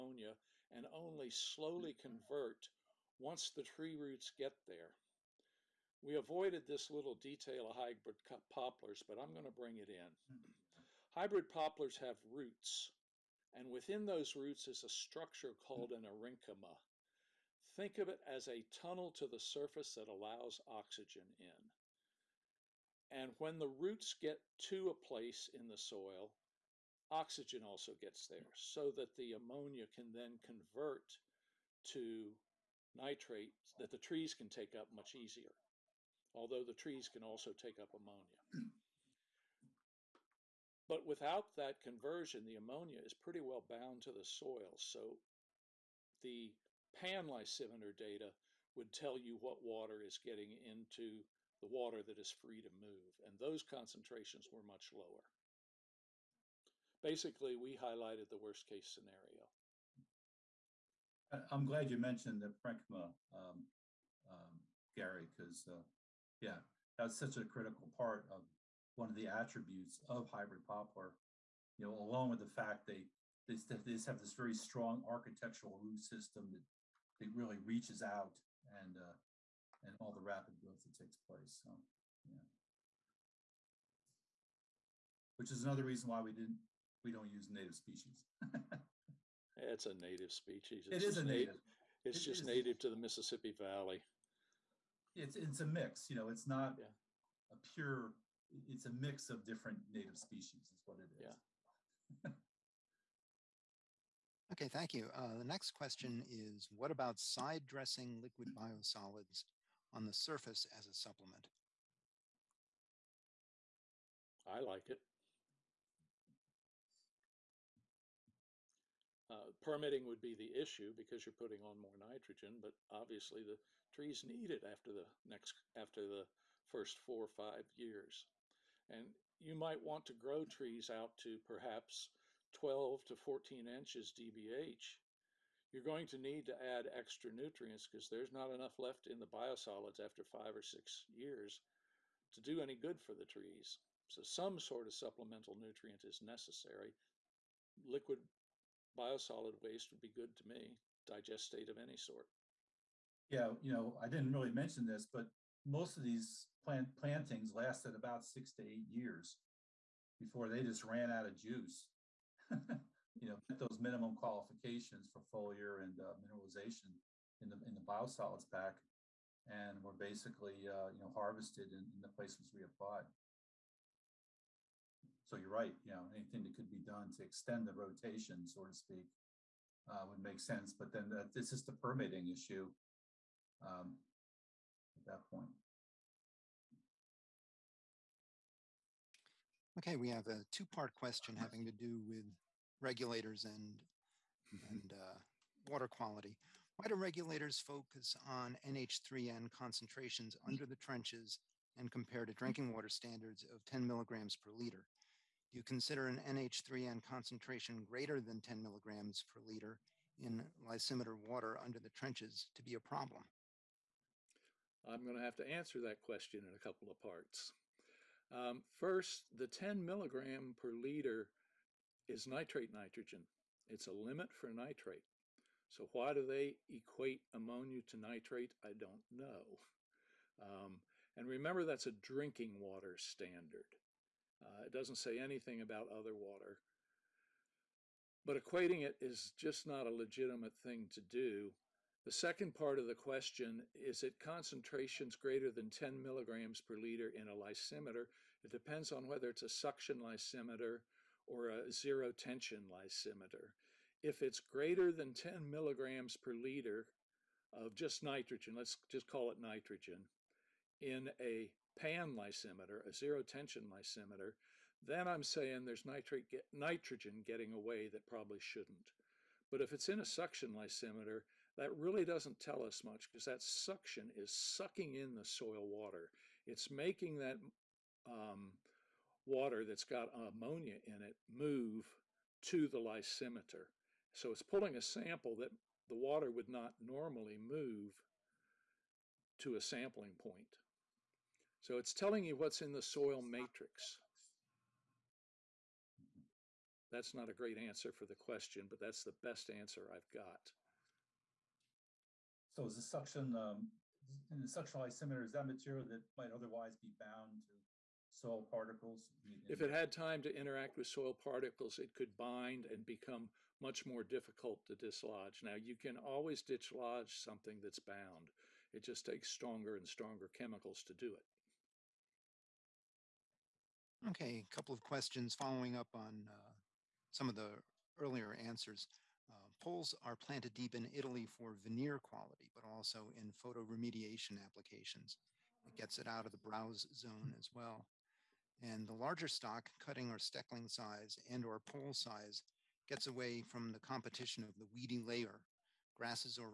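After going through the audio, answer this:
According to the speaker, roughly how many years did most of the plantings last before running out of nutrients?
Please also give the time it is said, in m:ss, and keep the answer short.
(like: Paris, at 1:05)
6 to 8 years, at 2:38.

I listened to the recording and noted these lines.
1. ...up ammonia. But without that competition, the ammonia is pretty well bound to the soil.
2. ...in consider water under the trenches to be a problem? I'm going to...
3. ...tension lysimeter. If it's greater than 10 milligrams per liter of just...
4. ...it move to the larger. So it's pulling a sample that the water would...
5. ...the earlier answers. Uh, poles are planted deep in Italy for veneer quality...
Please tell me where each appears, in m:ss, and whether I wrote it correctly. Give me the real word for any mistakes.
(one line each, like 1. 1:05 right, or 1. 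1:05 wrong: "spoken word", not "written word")
1. 0:37 wrong: "conversion", not "competition"
2. 3:30 wrong: "lysimeter", not "consider"
3. 4:12 right
4. 4:41 wrong: "lysimeter", not "larger"
5. 5:27 right.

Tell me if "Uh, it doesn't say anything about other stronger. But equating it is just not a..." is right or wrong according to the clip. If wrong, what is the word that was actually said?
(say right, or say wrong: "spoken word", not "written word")
wrong: "water", not "stronger".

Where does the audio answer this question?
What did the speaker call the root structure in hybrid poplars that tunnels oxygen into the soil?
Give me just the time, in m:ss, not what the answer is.
0:16.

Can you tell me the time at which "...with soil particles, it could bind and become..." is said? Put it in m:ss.
5:10.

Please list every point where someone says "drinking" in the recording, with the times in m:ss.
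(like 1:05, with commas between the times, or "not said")
3:22, 3:51.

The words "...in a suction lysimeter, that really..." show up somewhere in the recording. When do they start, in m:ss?
4:29.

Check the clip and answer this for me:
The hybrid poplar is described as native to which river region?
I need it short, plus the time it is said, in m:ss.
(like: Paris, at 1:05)
Mississippi Valley, at 1:32.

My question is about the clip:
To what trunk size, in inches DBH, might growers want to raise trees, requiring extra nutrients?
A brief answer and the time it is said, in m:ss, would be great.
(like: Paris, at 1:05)
12 to 14, at 2:12.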